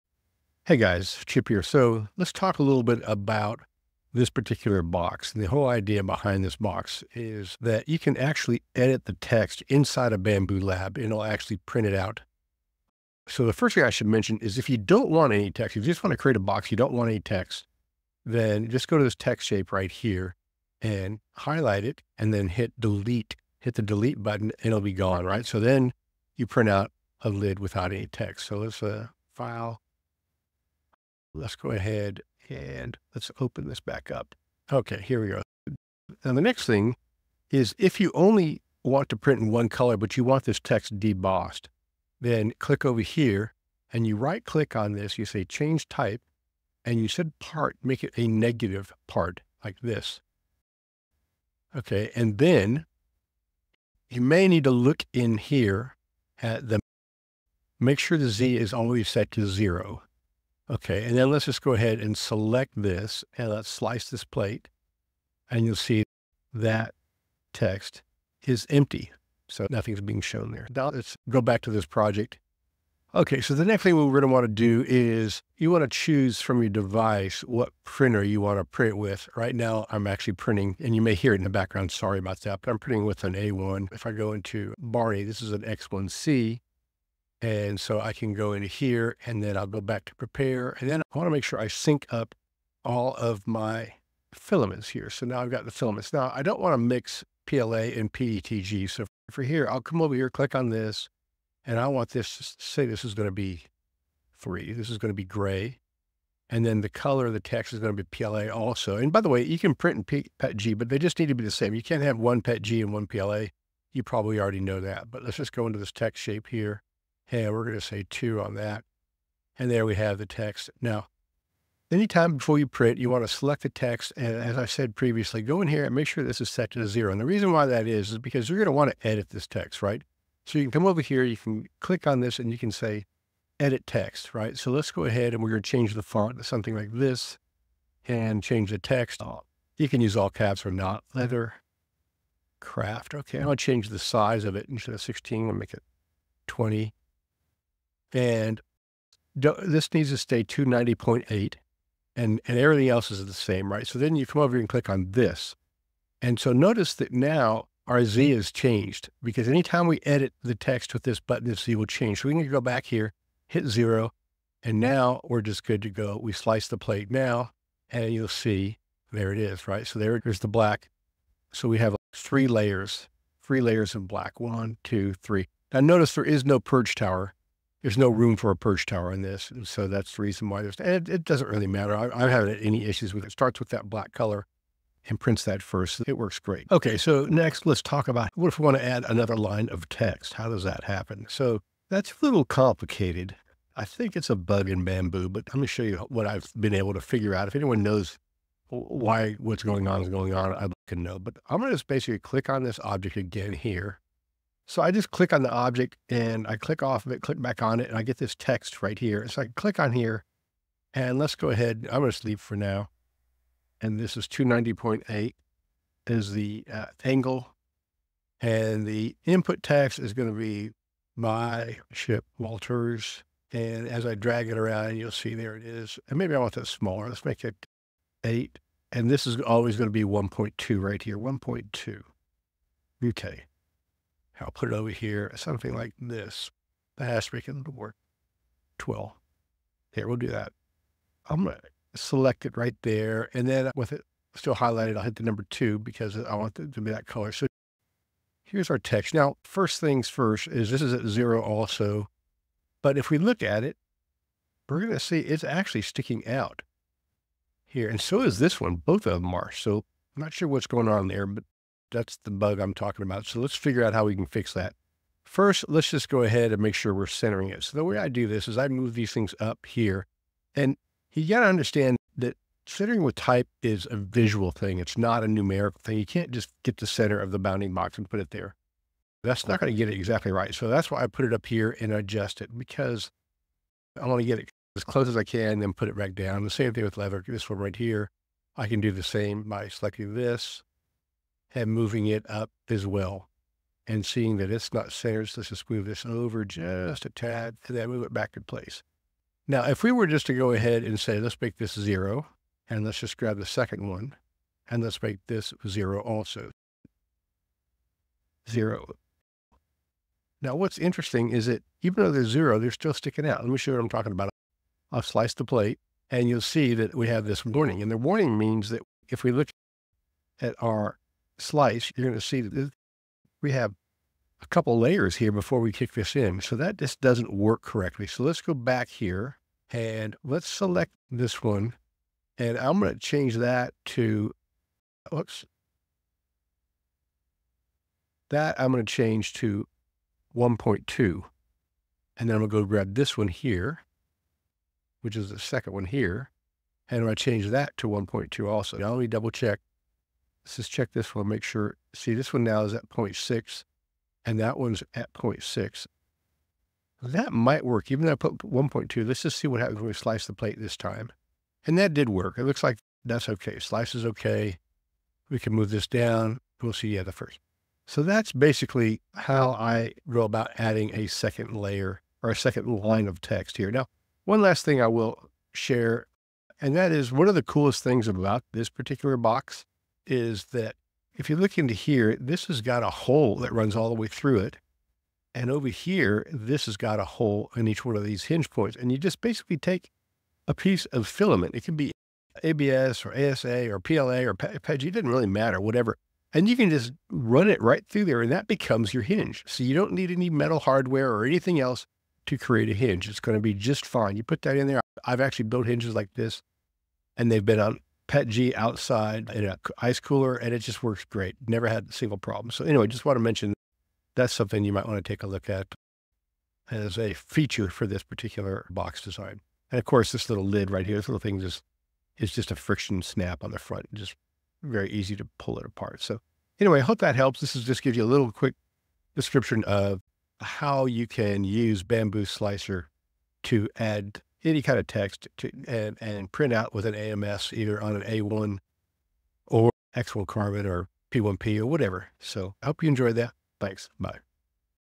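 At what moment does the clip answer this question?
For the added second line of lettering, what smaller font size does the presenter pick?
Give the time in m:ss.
3:48.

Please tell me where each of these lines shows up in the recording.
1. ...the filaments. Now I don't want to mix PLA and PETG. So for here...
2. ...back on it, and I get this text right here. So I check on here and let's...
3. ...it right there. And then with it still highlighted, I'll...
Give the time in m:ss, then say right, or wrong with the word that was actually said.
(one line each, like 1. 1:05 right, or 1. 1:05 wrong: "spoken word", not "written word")
1. 1:35 right
2. 3:27 wrong: "click", not "check"
3. 4:02 right.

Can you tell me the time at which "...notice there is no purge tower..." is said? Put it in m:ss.
2:55.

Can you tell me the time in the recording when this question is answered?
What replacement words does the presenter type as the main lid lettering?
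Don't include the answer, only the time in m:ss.
2:21.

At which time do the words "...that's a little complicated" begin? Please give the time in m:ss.
3:11.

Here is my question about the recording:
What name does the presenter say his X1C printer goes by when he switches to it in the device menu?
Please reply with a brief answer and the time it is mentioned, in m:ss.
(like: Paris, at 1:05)
Barney, at 1:24.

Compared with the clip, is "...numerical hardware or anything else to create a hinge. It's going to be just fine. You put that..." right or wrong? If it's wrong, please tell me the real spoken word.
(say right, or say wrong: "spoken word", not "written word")
wrong: "metal", not "numerical".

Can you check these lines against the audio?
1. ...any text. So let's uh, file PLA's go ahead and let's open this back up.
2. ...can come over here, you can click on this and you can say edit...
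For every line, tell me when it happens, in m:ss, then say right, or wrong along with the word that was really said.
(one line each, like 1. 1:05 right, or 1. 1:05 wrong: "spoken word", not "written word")
1. 0:27 wrong: "Let", not "PLA"
2. 2:10 right.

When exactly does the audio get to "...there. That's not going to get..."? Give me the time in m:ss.
4:38.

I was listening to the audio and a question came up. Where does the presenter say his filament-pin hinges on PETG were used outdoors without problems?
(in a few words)
an ice cooler.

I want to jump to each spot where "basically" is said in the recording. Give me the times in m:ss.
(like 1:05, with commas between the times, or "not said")
3:21, 6:08, 6:29.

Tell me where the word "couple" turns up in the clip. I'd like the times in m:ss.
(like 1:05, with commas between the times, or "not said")
5:24.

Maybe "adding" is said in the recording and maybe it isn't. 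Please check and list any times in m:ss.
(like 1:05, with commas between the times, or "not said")
6:10.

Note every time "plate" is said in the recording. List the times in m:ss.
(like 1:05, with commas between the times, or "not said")
1:04, 2:46, 5:15, 6:00.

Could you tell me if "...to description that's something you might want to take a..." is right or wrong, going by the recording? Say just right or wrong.
wrong.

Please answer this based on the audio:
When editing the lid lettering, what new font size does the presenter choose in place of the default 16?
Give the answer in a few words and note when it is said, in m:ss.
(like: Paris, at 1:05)
20, at 2:26.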